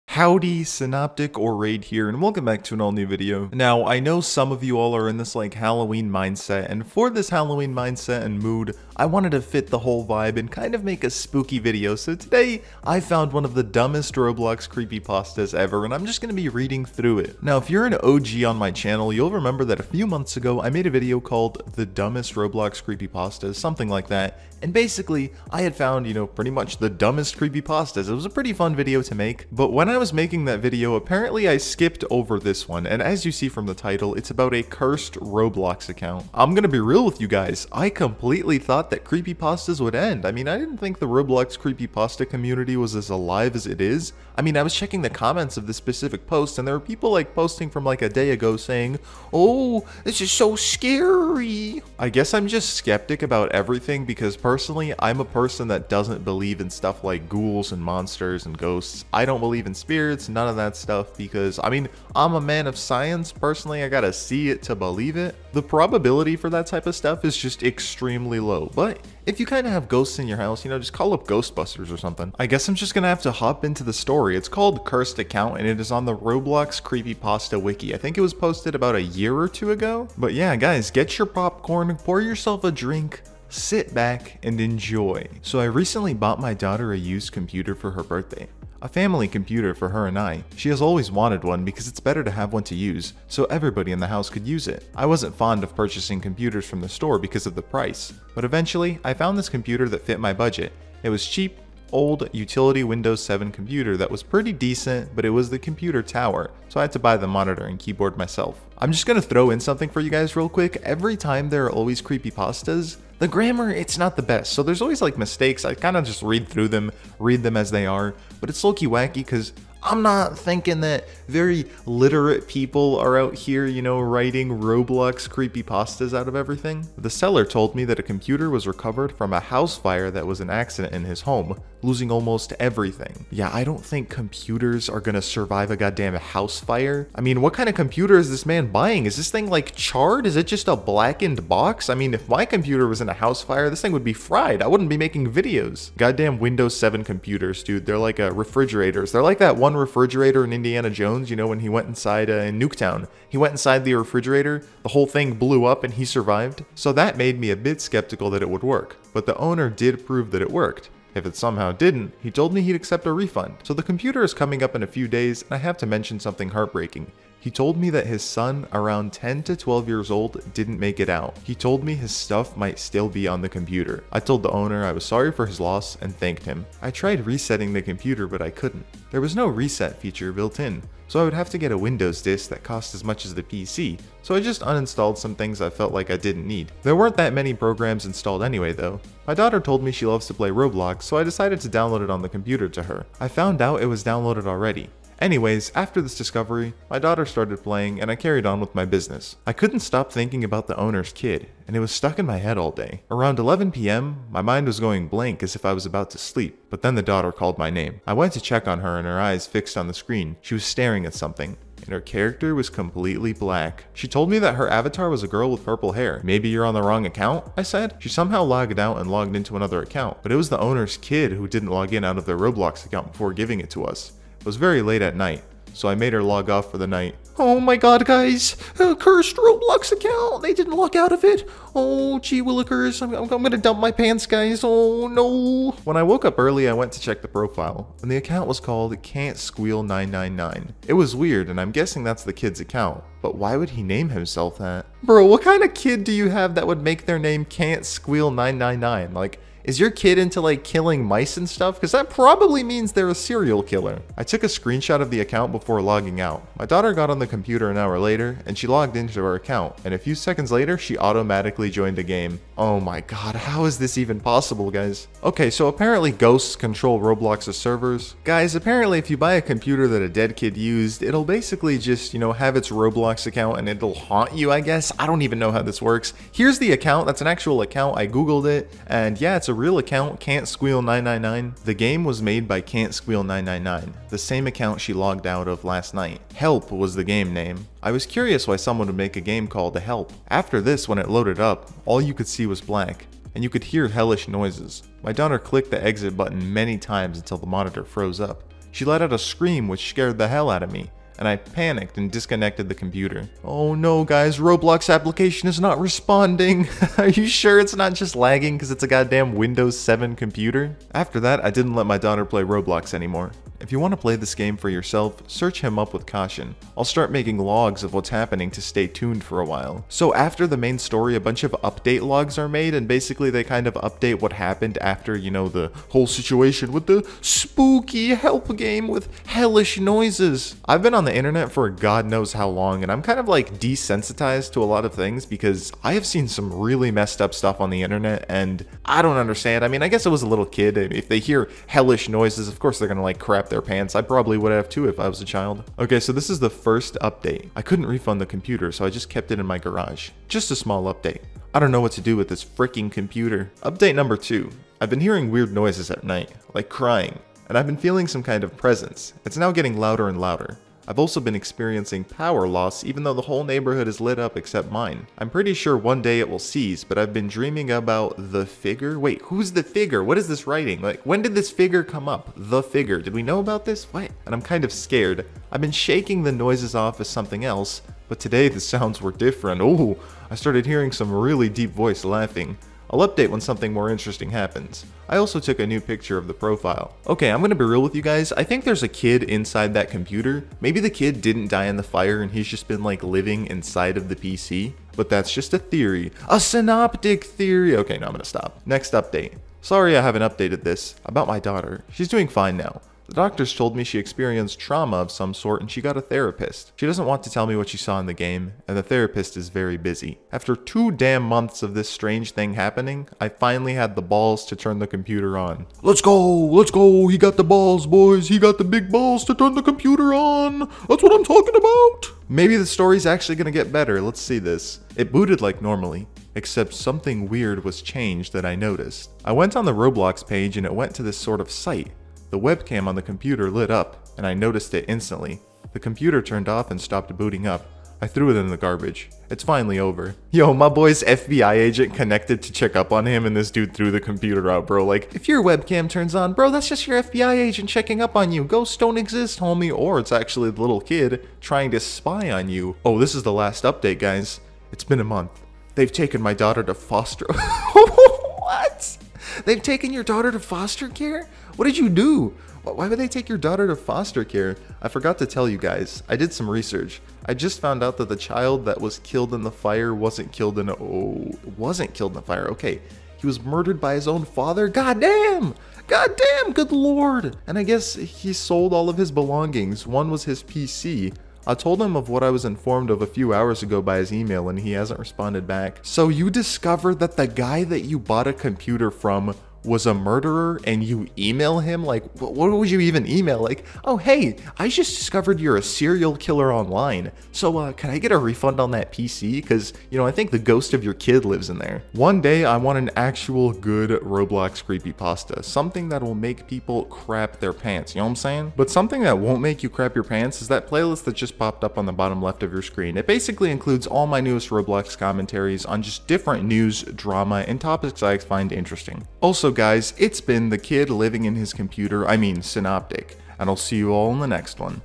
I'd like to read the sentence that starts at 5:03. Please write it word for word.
Oh no guys, Roblox application is not responding.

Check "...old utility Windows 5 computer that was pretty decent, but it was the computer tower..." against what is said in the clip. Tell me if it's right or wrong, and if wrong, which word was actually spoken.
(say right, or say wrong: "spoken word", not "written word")
wrong: "7", not "5".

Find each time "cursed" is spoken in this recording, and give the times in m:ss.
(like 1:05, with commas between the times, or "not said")
0:34, 1:14, 3:48.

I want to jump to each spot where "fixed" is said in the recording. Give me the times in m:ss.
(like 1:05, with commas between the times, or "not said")
3:29.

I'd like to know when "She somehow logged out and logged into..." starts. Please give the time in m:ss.
3:37.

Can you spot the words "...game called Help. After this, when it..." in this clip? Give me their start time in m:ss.
4:49.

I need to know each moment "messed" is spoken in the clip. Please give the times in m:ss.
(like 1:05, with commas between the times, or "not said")
5:36.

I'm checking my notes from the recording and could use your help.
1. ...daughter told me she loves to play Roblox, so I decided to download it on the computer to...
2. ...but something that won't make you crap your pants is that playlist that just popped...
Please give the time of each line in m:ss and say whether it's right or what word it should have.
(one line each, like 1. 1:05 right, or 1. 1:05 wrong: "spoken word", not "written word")
1. 3:09 right
2. 8:28 right.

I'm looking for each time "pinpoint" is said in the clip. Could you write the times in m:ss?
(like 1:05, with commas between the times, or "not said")
not said.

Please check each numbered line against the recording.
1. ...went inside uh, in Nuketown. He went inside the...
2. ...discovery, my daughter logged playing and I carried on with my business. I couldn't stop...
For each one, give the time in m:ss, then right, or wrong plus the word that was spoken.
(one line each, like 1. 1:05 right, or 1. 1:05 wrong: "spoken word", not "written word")
1. 2:31 right
2. 3:16 wrong: "started", not "logged".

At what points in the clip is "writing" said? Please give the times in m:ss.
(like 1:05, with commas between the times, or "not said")
2:03, 6:10.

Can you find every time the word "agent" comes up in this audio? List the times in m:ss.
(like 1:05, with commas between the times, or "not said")
7:21, 7:27.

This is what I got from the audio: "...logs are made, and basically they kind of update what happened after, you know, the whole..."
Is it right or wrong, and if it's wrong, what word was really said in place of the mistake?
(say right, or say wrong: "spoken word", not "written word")
right.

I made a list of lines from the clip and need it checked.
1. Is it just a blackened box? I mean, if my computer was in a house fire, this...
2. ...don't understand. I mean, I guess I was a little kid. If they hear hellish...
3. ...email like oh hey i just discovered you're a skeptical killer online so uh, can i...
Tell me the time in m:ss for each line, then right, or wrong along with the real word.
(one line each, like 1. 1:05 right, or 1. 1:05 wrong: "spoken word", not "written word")
1. 2:20 right
2. 5:39 right
3. 8:13 wrong: "serial", not "skeptical".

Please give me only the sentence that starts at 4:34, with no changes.
I don't even know how this works.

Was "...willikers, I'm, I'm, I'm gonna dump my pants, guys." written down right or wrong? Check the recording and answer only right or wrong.
right.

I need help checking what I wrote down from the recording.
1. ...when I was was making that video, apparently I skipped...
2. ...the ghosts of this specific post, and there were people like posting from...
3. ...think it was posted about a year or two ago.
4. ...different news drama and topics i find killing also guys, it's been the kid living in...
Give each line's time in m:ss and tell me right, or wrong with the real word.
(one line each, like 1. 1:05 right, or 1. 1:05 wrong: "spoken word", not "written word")
1. 0:29 right
2. 0:45 wrong: "comments", not "ghosts"
3. 1:17 right
4. 8:36 wrong: "interesting", not "killing".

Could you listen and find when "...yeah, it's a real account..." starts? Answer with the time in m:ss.
4:39.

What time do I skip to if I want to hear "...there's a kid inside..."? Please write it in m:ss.
6:28.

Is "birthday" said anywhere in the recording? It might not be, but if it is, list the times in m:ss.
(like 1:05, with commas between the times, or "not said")
1:28.